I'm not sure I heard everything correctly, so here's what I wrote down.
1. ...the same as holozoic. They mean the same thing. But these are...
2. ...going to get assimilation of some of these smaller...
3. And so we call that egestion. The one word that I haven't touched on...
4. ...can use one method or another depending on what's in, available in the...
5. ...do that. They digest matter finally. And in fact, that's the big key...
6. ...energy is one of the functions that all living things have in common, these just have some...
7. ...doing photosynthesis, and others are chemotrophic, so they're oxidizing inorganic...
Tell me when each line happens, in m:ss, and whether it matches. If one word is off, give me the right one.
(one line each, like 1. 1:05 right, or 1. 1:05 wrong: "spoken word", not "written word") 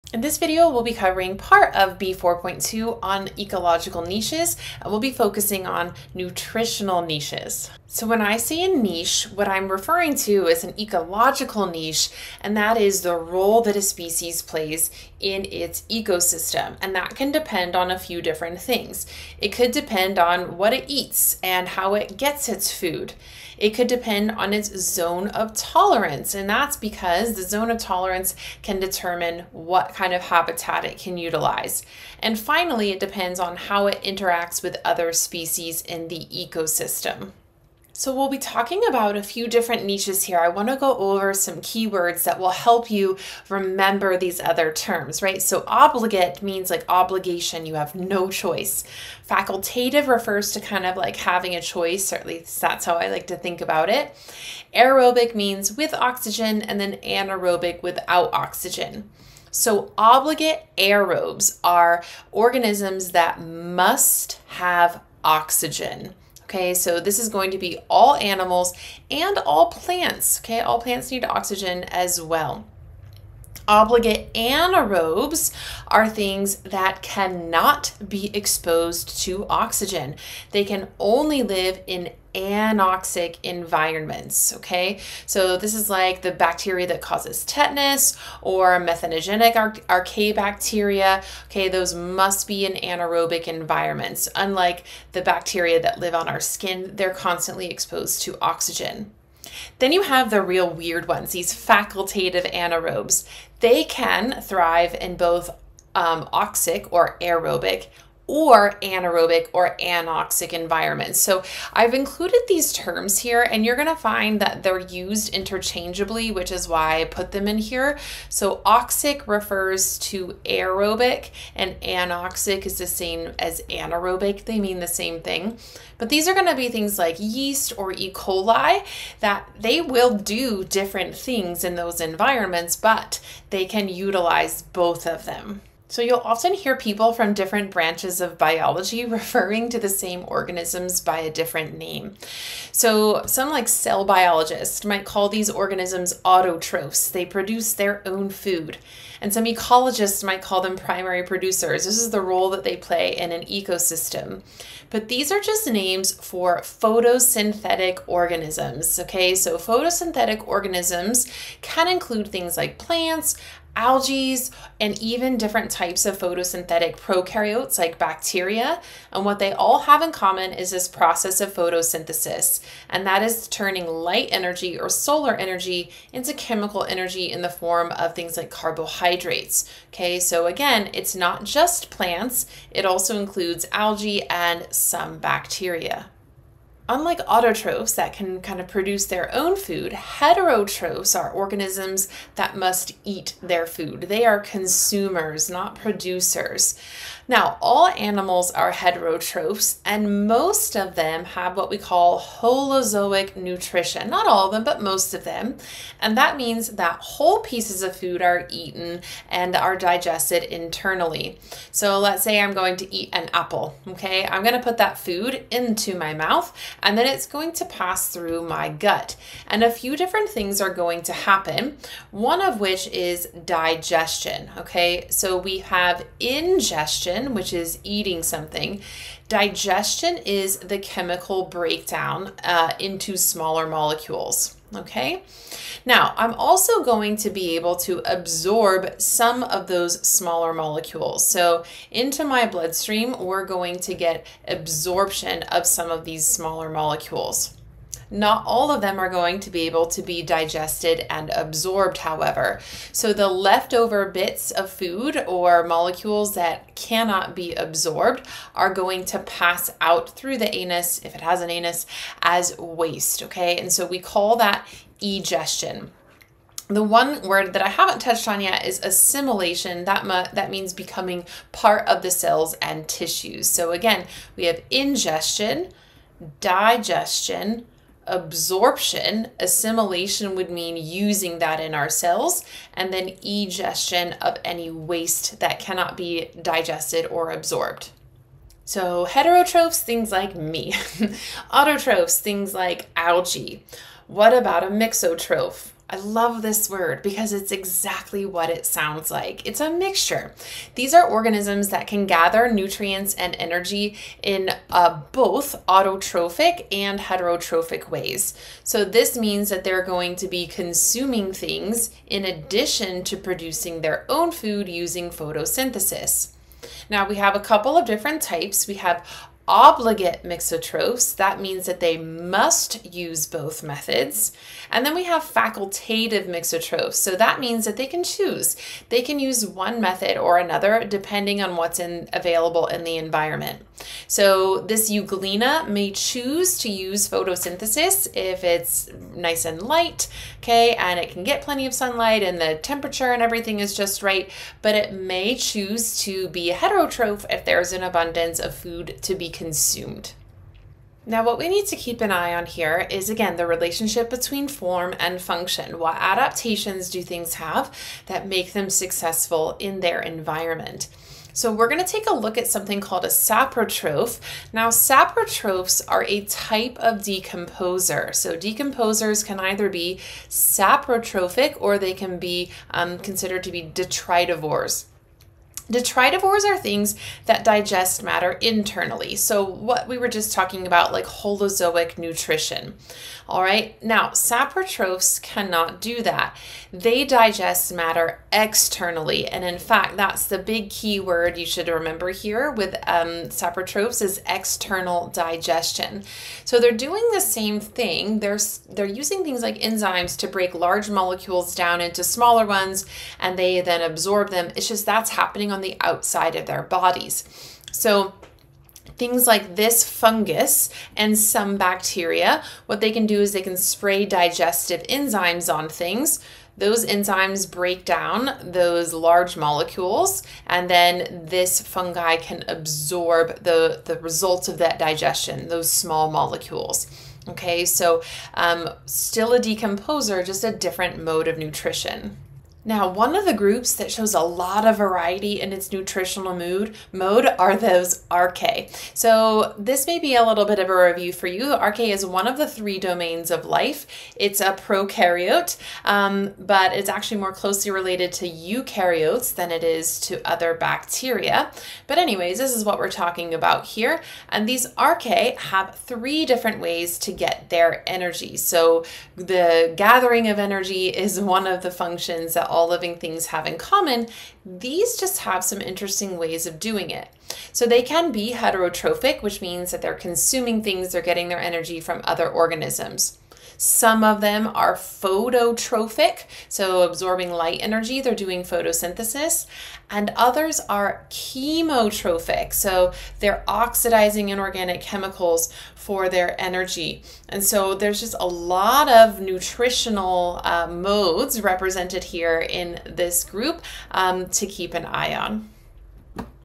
1. 2:02 wrong: "anaerobic", not "holozoic"
2. 4:03 wrong: "absorption", not "assimilation"
3. 4:23 right
4. 5:29 right
5. 6:25 wrong: "externally", not "finally"
6. 7:40 right
7. 7:58 right.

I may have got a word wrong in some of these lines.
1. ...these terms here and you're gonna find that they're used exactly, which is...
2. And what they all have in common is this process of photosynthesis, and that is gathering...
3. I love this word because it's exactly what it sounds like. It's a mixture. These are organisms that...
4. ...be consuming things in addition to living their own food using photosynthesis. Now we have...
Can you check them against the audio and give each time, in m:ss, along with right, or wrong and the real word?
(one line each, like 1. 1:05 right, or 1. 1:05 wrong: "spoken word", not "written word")
1. 1:52 wrong: "interchangeably", not "exactly"
2. 2:49 wrong: "turning", not "gathering"
3. 4:55 right
4. 5:10 wrong: "producing", not "living".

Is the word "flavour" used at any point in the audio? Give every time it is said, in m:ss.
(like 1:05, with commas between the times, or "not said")
not said.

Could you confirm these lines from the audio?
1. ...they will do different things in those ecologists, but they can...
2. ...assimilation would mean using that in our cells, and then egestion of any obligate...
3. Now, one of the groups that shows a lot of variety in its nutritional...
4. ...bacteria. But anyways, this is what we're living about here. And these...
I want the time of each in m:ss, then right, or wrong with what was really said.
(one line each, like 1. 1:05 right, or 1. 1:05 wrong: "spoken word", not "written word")
1. 2:09 wrong: "environments", not "ecologists"
2. 4:39 wrong: "waste", not "obligate"
3. 7:12 right
4. 7:30 wrong: "talking", not "living".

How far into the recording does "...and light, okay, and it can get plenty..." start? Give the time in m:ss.
5:39.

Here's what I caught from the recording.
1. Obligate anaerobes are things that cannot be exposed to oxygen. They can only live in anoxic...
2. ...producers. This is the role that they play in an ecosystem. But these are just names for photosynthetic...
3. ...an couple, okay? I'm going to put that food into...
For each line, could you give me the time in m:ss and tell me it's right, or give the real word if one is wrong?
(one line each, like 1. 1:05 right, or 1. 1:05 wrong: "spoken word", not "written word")
1. 1:13 right
2. 2:31 right
3. 3:33 wrong: "apple", not "couple".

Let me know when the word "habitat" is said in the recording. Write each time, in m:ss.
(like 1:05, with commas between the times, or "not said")
0:30.